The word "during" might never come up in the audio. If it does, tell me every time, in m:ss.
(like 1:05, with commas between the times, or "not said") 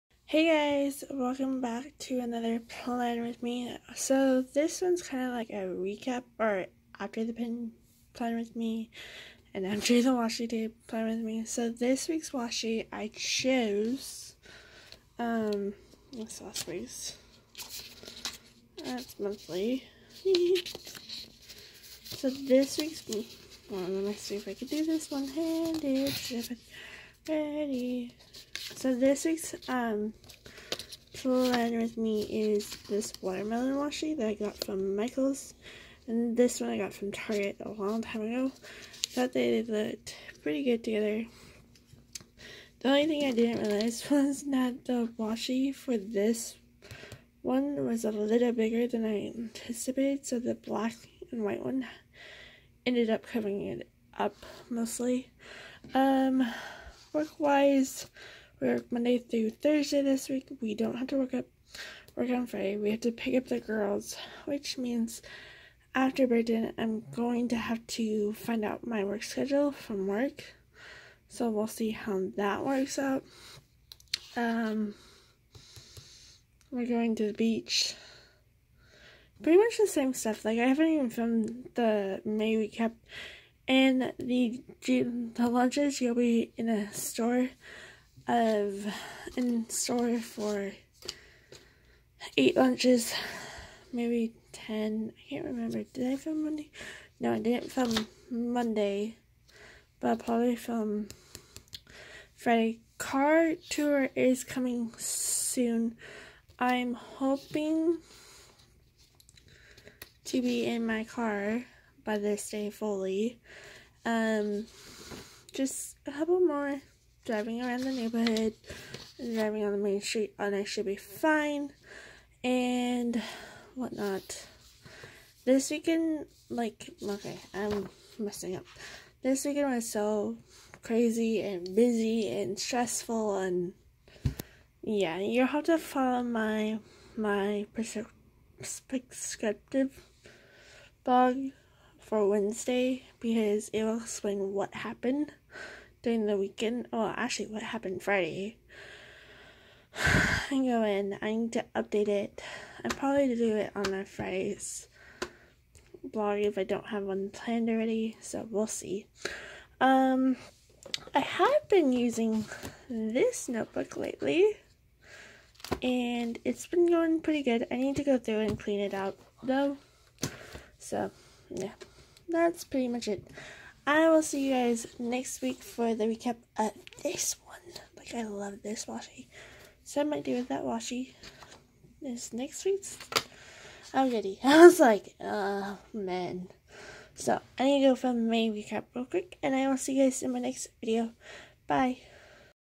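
2:26.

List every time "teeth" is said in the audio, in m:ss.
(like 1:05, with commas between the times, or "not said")
not said.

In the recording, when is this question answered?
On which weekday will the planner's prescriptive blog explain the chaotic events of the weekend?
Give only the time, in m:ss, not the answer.
2:22.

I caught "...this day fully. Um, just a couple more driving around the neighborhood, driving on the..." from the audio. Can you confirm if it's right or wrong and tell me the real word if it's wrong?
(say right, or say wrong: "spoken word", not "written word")
right.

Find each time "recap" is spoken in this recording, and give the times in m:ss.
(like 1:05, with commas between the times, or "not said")
0:05, 2:56, 3:08.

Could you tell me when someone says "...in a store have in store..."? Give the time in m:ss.
1:26.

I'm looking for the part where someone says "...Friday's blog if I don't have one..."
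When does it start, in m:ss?
2:34.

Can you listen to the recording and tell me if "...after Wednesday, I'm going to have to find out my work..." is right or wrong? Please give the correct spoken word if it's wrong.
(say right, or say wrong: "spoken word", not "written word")
wrong: "Britain", not "Wednesday".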